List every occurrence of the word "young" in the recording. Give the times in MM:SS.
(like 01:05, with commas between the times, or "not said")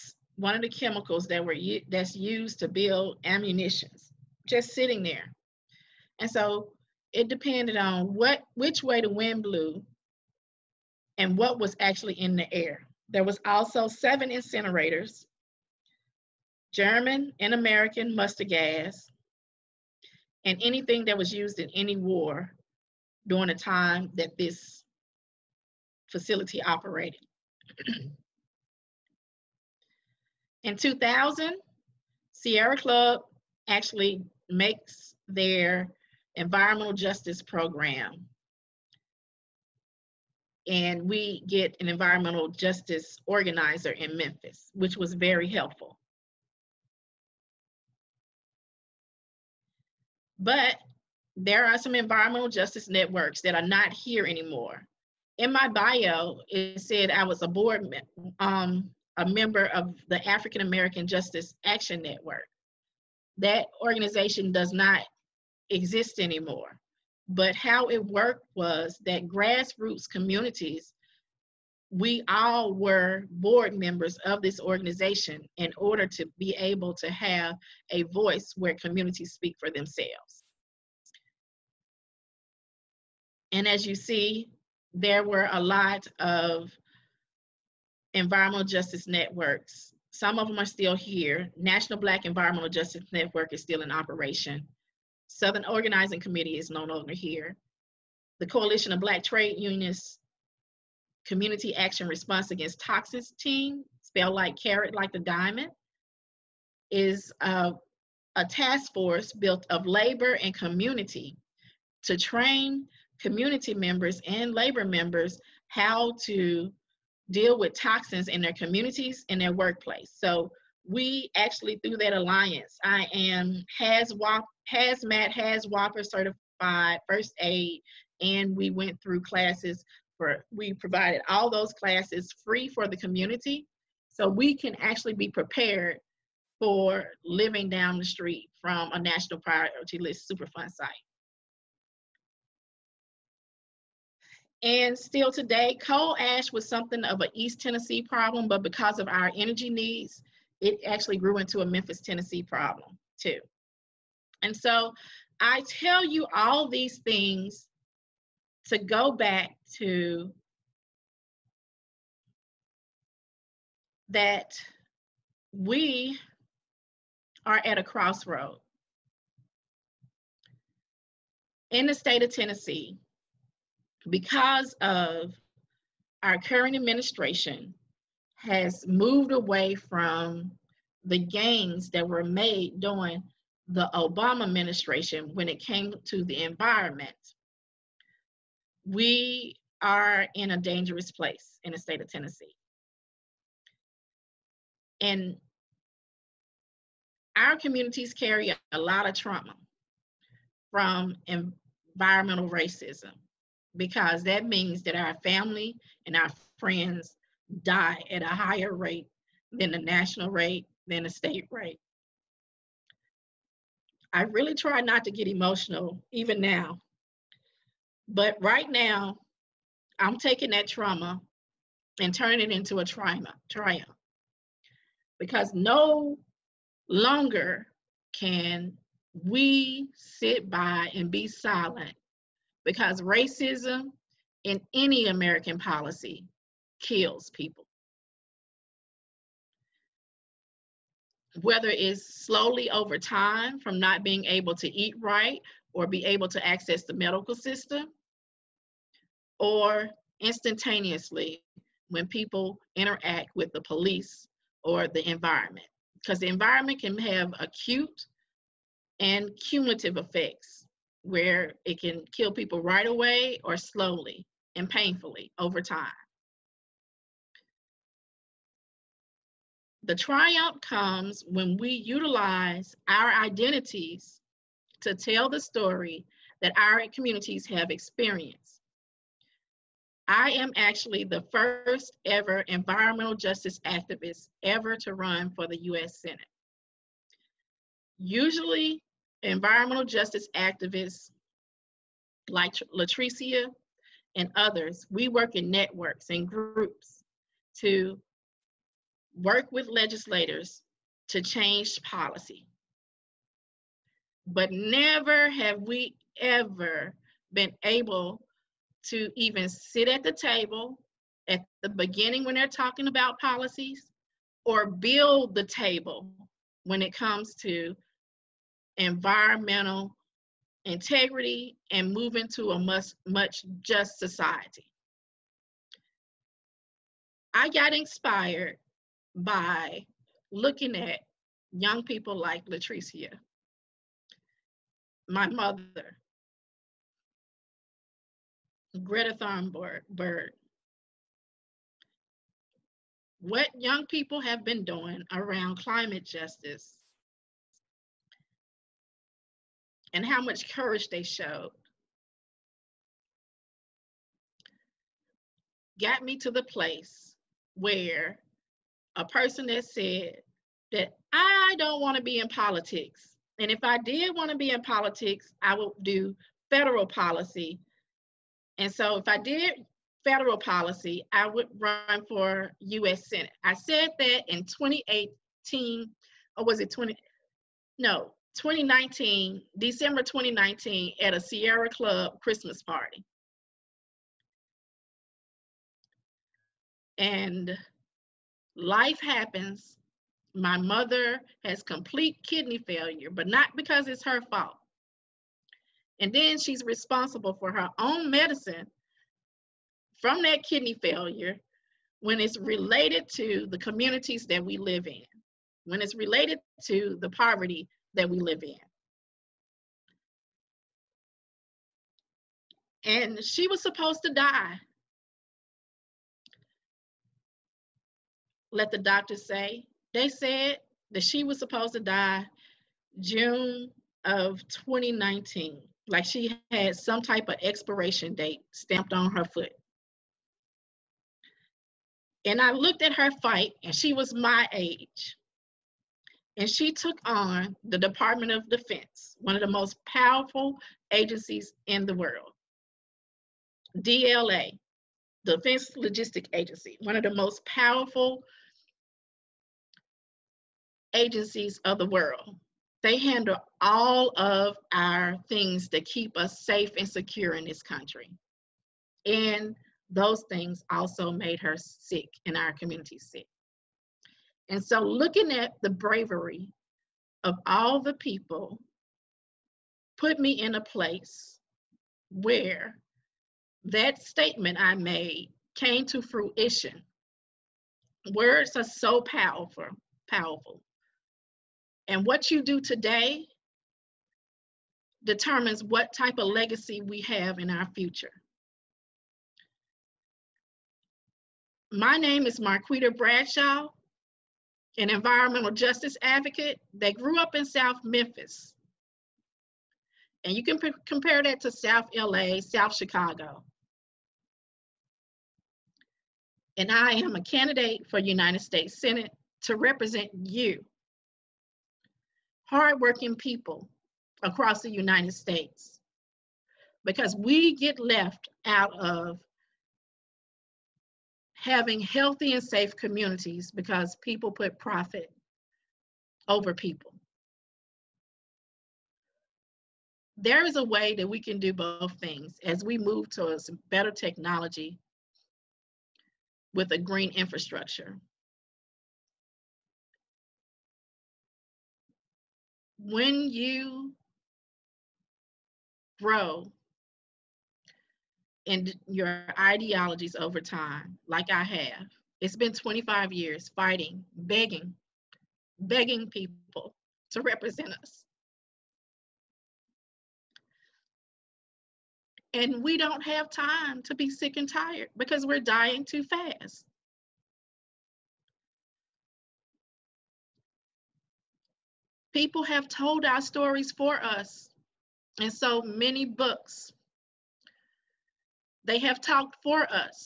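05:31, 05:43.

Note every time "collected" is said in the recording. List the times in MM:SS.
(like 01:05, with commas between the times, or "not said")
not said.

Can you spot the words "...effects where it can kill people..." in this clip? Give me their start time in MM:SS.
04:19.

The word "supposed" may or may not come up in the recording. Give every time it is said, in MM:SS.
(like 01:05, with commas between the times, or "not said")
06:53, 07:01.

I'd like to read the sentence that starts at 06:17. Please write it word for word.
No, 2019, December 2019, at a Sierra Club Christmas party.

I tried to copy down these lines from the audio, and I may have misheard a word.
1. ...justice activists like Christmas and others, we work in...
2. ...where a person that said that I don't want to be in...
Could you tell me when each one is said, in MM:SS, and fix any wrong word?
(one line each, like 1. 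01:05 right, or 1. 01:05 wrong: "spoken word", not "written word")
1. 04:49 wrong: "LaTricea", not "Christmas"
2. 05:57 right.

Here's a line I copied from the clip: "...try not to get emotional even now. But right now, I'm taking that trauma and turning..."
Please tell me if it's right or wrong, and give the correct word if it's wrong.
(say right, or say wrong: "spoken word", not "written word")
right.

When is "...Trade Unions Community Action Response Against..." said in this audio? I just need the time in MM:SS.
01:39.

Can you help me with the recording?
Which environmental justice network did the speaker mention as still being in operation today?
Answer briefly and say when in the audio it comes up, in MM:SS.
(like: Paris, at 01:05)
National Black Environmental Justice Network, at 01:31.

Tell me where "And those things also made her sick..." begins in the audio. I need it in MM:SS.
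07:39.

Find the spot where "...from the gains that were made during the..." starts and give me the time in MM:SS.
02:59.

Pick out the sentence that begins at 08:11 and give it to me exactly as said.
My name is Marquita Bradshaw, an environmental justice advocate that grew up in South Memphis.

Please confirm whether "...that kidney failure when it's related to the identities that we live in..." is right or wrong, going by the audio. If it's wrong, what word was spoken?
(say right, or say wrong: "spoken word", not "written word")
wrong: "communities", not "identities".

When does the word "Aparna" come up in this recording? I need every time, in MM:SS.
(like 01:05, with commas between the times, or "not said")
not said.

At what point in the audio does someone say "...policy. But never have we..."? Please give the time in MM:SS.
05:01.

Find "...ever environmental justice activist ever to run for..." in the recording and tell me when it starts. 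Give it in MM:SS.
04:42.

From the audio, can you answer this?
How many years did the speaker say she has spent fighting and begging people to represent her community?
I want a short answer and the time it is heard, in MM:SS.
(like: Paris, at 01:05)
25, at 09:12.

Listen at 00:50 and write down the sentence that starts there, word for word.
But there are some environmental justice networks that are not here anymore.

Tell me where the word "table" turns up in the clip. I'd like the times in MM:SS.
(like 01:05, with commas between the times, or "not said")
05:10, 05:15.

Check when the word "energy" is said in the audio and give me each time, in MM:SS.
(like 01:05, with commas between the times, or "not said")
02:29.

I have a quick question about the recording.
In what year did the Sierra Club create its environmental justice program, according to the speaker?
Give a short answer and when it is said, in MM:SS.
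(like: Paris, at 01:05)
2000, at 00:30.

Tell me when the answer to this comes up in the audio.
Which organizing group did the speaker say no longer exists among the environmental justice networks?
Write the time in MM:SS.
01:35.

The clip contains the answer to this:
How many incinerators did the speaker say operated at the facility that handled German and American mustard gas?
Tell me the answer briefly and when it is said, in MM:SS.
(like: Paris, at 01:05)
7, at 00:13.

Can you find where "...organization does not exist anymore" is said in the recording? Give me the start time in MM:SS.
01:03.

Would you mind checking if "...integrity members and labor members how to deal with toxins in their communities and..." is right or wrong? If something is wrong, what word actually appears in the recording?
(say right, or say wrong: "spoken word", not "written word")
wrong: "community", not "integrity".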